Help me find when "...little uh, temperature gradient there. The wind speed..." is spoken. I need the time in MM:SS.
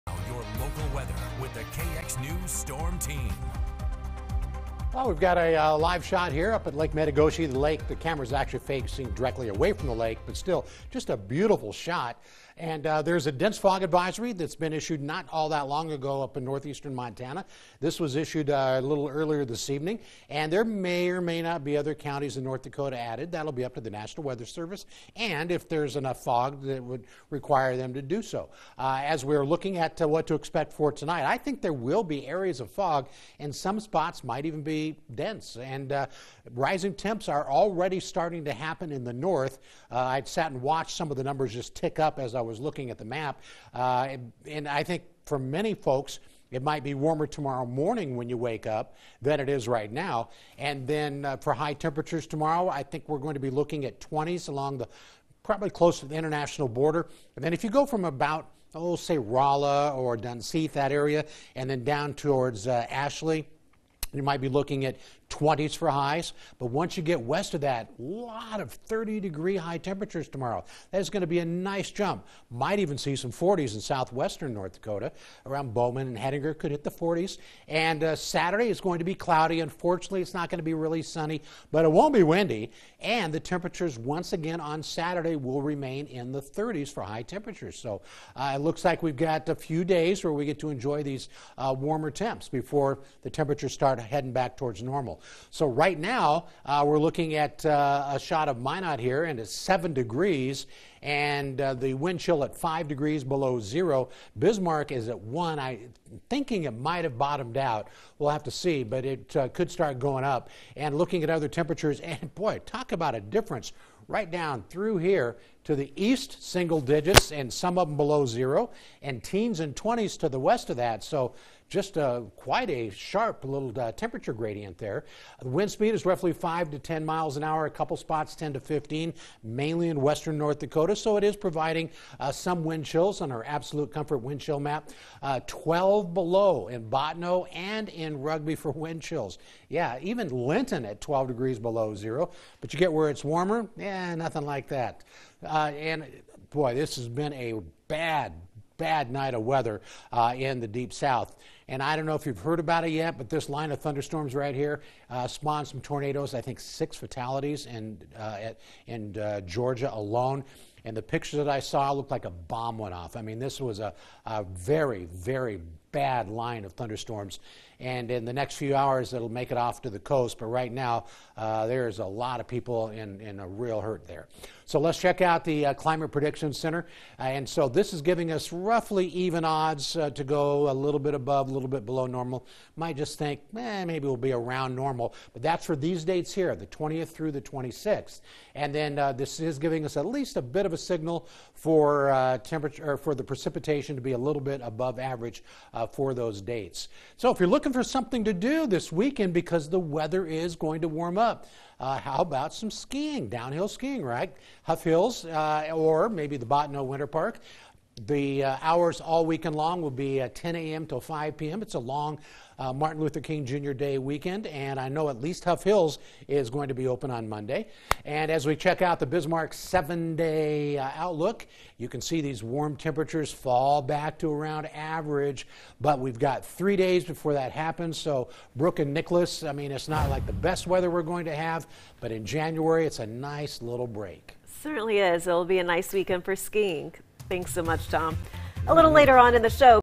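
02:03.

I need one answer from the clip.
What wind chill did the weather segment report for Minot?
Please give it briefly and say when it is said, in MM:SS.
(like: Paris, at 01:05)
-5 degrees, at 01:42.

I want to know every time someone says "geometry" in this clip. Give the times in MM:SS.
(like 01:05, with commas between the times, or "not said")
not said.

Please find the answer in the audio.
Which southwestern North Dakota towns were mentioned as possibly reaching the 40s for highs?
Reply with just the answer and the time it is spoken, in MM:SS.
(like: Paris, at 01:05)
Bowman and Hettinger, at 01:15.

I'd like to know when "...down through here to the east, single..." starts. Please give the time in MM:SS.
01:54.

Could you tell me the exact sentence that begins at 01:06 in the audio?
But once you get west of that, a lot of 30 degree high temperatures tomorrow.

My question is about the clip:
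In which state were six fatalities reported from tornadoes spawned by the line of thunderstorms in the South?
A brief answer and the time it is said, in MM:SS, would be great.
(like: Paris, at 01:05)
Georgia, at 02:39.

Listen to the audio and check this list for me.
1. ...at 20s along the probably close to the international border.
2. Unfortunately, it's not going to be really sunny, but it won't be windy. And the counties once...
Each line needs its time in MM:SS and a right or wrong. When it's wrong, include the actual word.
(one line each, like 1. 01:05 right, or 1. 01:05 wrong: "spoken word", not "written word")
1. 00:53 right
2. 01:19 wrong: "temperatures", not "counties".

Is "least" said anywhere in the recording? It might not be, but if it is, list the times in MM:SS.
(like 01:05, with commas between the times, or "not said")
03:10, 03:35.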